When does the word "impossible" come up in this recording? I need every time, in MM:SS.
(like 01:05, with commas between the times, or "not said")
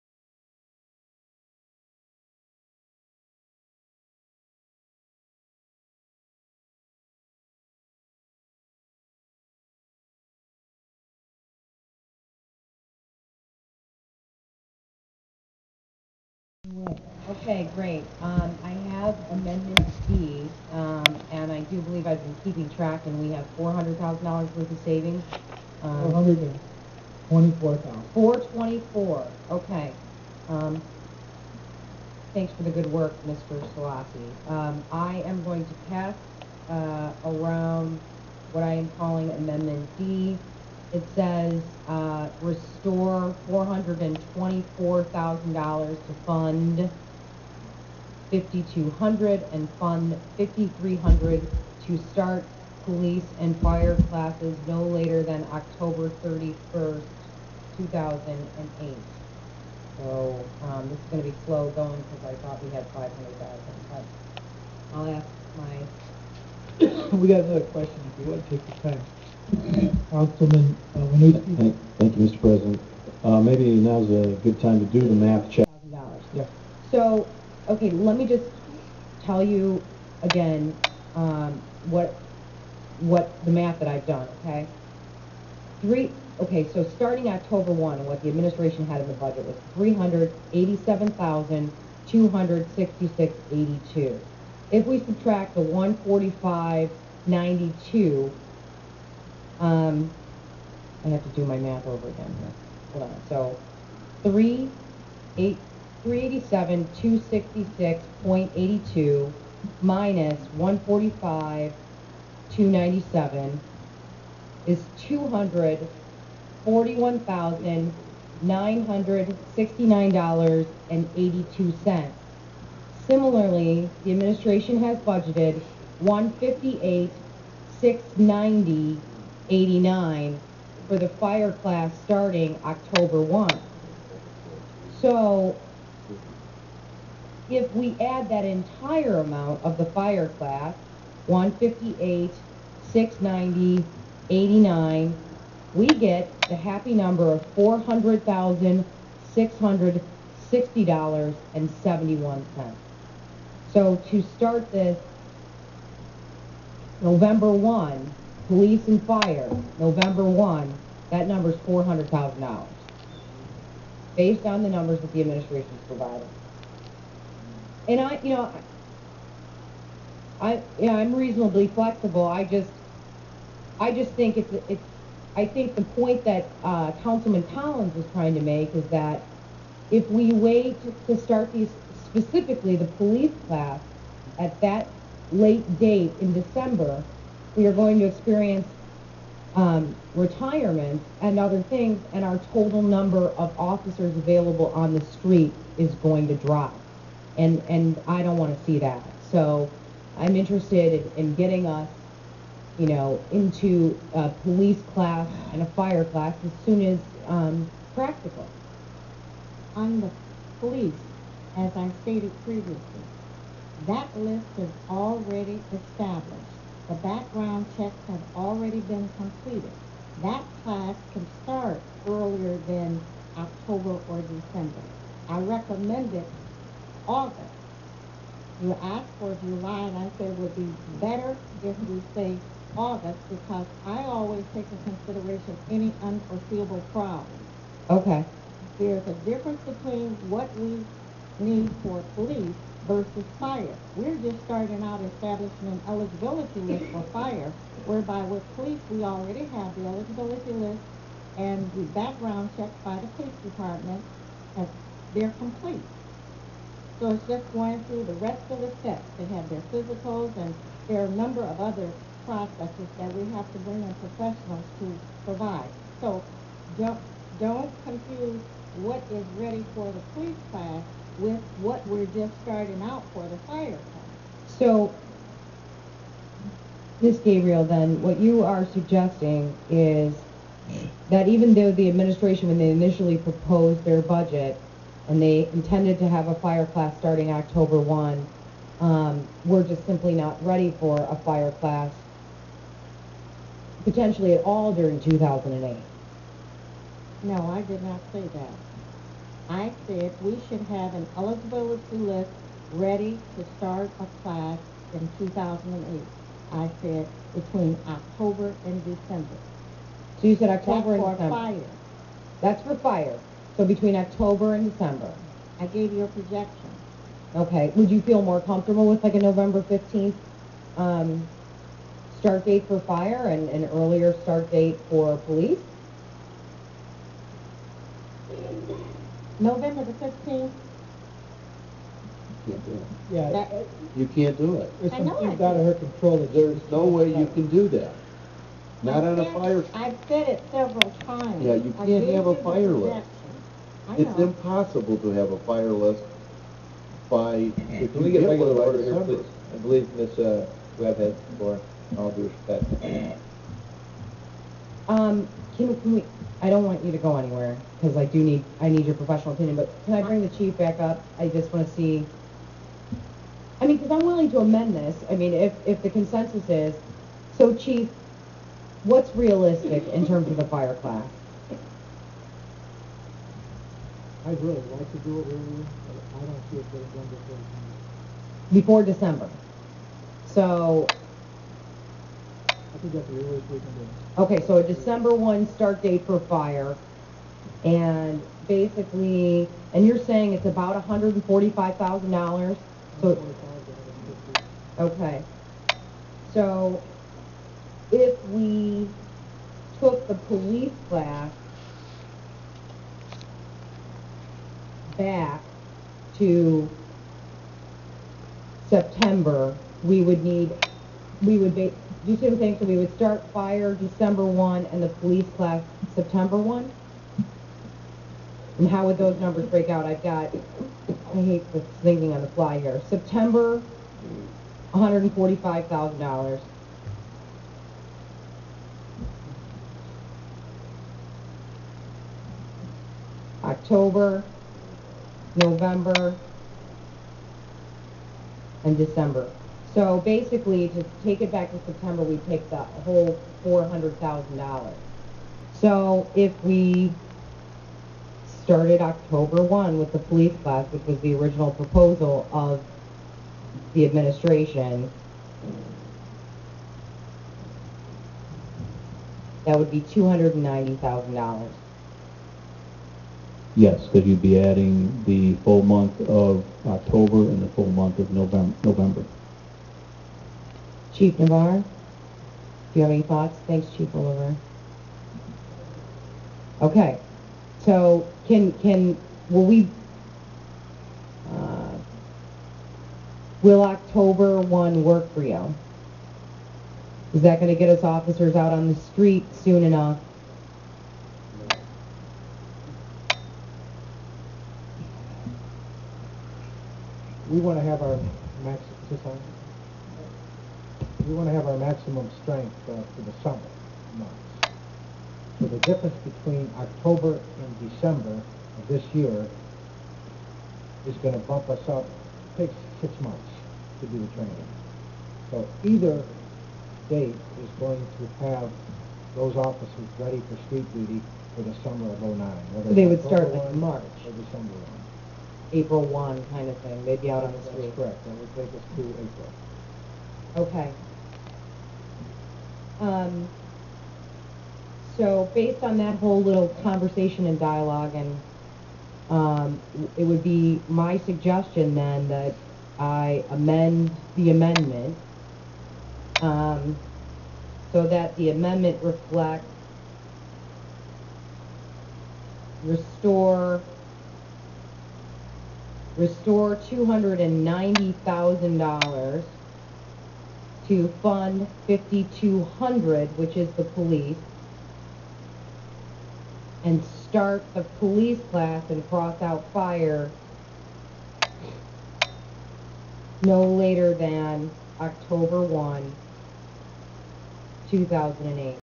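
05:44.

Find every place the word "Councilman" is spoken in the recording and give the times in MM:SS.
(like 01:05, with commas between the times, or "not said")
01:10, 02:57.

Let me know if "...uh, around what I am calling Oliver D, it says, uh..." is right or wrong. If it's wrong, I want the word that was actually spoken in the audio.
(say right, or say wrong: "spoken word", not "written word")
wrong: "Amendment", not "Oliver".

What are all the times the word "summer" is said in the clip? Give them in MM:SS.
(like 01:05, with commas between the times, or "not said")
08:23, 08:41.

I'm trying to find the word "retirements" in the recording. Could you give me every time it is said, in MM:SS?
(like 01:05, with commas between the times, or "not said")
03:10.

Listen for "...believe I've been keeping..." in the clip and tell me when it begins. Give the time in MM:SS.
00:21.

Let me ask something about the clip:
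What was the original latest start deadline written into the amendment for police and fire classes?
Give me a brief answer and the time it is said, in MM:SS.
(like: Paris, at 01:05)
October 31, 2008, at 00:55.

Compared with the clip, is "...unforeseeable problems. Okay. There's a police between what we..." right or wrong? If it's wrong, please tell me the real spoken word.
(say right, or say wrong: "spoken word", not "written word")
wrong: "difference", not "police".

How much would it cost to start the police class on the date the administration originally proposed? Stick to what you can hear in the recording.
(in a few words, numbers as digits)
$290,000.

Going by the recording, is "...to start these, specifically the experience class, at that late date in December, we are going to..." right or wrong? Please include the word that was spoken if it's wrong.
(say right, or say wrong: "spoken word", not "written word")
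wrong: "police", not "experience".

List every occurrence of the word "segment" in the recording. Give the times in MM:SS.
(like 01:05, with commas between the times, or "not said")
not said.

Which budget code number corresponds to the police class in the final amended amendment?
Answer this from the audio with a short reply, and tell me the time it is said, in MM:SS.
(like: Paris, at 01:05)
5200, at 09:21.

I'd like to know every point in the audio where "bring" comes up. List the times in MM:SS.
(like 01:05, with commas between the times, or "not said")
04:23, 06:00.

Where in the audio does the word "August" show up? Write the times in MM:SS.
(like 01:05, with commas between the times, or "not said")
03:47, 03:52.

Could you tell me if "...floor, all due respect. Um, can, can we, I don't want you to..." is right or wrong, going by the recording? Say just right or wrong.
right.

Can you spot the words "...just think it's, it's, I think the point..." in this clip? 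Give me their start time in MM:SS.
02:53.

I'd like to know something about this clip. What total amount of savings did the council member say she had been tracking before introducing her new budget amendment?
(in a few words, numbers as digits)
$424,000.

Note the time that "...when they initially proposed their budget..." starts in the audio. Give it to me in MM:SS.
04:42.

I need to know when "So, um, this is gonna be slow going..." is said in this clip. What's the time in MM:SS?
00:59.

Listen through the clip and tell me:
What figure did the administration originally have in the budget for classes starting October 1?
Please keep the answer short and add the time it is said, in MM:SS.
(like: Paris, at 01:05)
$387,266.82, at 01:29.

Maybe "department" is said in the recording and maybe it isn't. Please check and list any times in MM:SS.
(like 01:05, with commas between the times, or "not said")
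04:13.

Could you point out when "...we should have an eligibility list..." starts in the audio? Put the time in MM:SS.
05:00.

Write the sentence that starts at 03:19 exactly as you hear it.
So I'm interested in, in getting us, you know, into a police class and a fire class as soon as um, practical.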